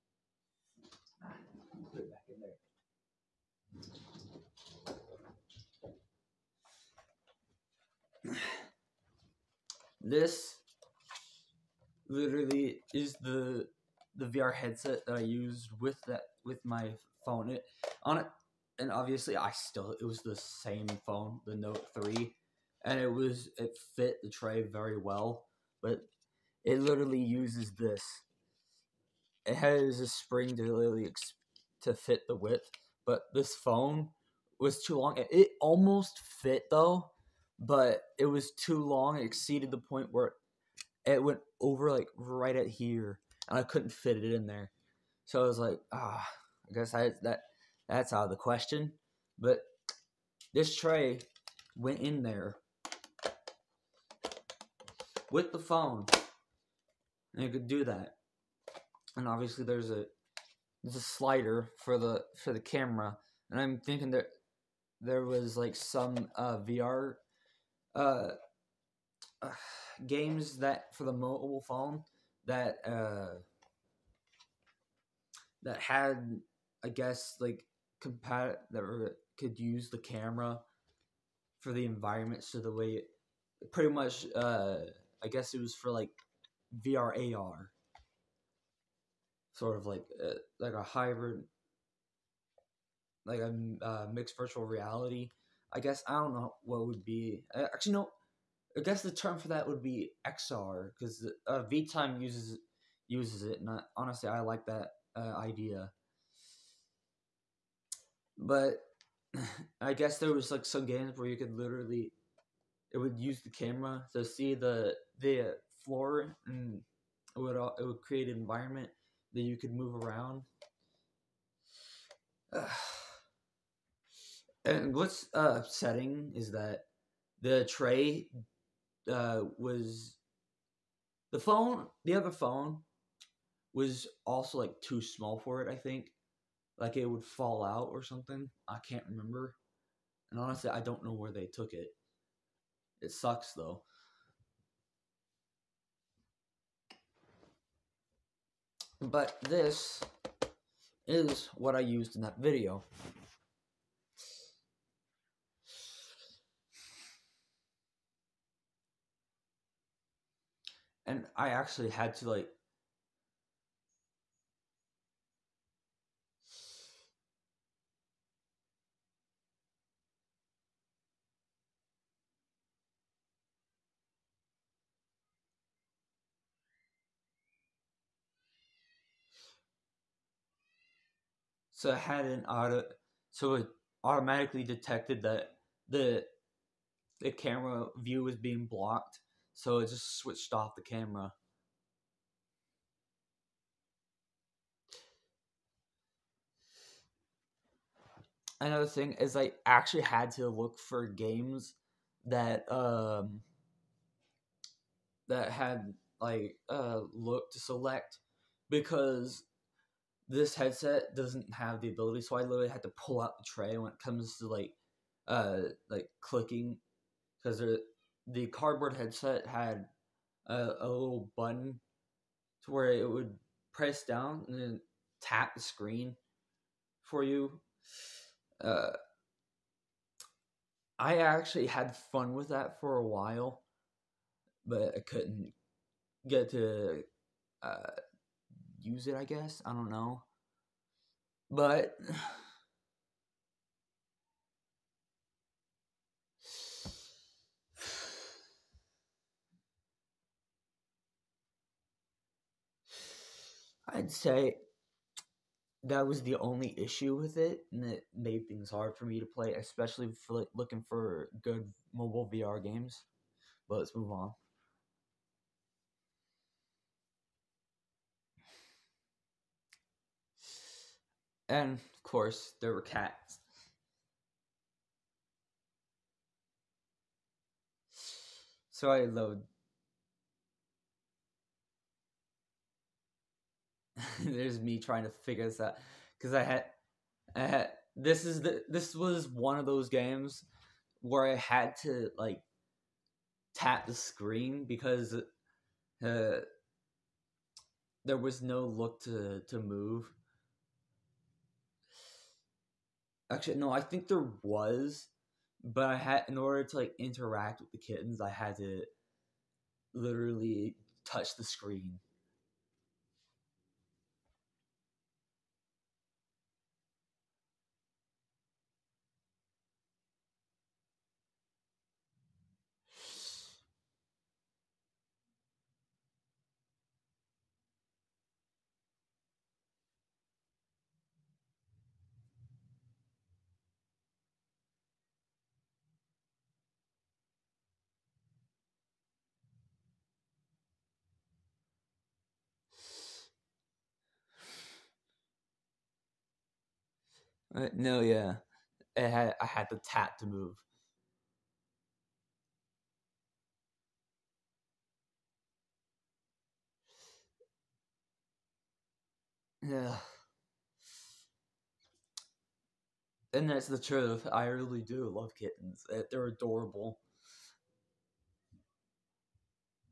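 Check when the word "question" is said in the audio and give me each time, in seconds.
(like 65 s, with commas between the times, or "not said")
48 s.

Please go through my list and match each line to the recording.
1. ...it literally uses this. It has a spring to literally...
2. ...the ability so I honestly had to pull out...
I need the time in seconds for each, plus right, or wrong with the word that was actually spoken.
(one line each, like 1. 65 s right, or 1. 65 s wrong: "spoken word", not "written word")
1. 26 s right
2. 211 s wrong: "literally", not "honestly".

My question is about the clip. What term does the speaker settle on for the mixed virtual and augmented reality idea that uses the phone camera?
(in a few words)
XR.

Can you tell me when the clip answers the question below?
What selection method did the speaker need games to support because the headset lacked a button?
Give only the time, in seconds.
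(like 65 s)
207 s.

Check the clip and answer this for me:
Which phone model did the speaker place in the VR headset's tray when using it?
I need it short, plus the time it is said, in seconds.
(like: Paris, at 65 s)
Note 3, at 21 s.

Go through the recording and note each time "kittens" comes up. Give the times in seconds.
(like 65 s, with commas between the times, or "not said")
307 s, 365 s.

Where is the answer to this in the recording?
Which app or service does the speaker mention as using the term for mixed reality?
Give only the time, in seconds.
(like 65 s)
101 s.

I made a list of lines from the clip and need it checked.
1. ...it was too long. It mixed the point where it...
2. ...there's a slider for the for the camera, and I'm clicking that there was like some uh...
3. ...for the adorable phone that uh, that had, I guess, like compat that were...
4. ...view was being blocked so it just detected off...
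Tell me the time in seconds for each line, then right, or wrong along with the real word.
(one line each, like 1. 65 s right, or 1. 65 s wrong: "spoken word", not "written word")
1. 38 s wrong: "exceeded", not "mixed"
2. 60 s wrong: "thinking", not "clicking"
3. 70 s wrong: "mobile", not "adorable"
4. 187 s wrong: "switched", not "detected".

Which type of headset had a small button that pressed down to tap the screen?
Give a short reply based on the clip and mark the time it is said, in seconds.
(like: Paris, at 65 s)
cardboard headset, at 218 s.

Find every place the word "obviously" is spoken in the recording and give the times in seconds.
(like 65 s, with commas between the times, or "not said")
18 s, 59 s.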